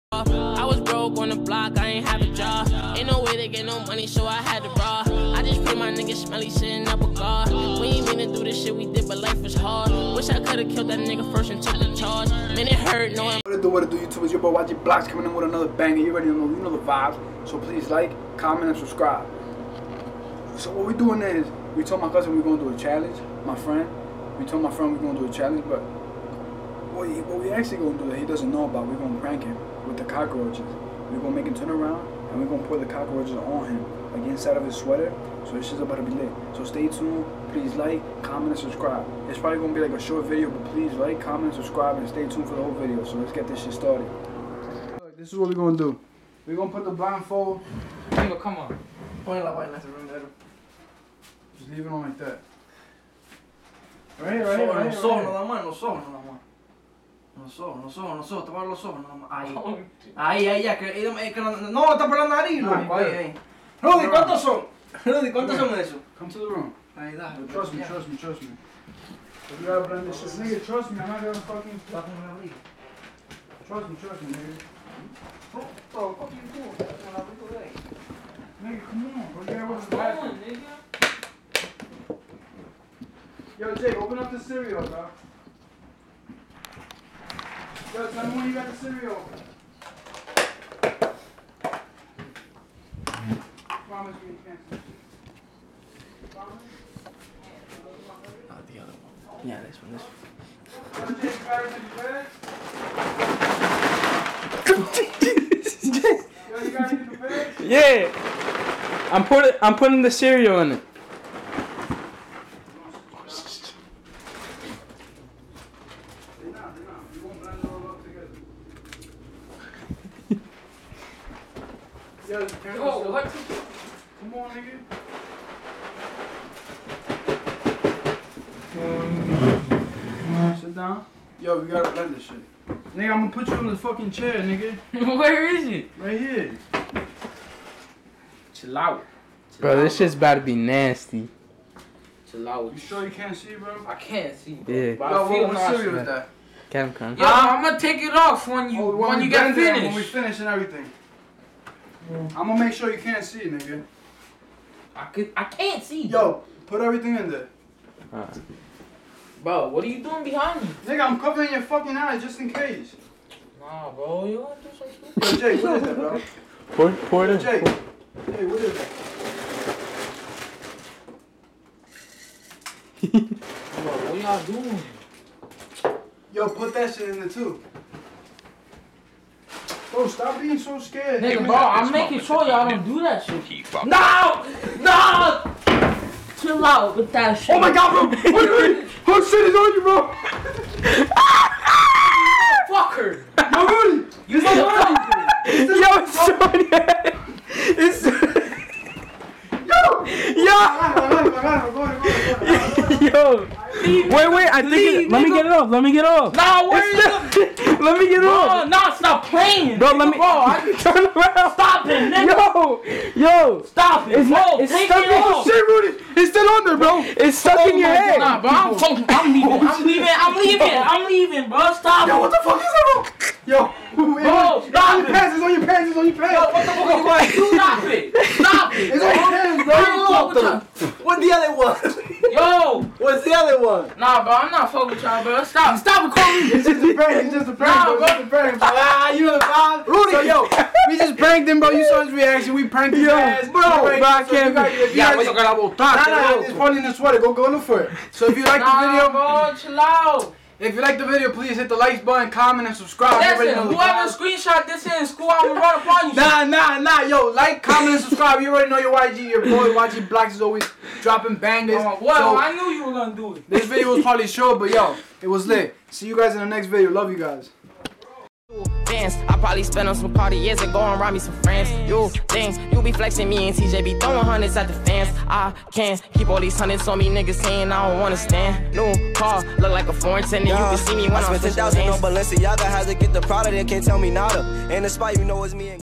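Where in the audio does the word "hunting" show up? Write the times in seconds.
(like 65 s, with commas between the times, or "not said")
not said.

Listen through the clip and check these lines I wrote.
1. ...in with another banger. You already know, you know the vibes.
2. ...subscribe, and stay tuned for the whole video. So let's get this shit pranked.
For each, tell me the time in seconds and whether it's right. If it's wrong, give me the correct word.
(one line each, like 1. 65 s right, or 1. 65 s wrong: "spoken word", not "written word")
1. 15 s right
2. 41 s wrong: "started", not "pranked".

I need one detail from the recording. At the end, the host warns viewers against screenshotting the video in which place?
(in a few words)
school.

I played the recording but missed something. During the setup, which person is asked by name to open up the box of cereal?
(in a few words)
Jake.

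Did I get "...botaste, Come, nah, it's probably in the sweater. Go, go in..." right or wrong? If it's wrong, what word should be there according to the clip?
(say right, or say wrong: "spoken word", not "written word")
wrong: "Nah", not "Come".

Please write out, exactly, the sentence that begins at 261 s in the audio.
Oh, well, so, I knew you were gonna do it.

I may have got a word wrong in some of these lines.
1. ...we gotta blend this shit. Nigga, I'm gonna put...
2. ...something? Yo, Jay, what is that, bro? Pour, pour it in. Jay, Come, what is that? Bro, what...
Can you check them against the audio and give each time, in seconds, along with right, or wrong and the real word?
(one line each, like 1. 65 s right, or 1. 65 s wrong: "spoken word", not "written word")
1. 131 s right
2. 165 s wrong: "Hey", not "Come".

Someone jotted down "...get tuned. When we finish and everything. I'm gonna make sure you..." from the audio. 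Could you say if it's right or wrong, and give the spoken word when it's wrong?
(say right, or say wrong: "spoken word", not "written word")
wrong: "finished", not "tuned".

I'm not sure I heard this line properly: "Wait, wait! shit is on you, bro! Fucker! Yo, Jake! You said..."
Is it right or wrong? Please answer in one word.
wrong.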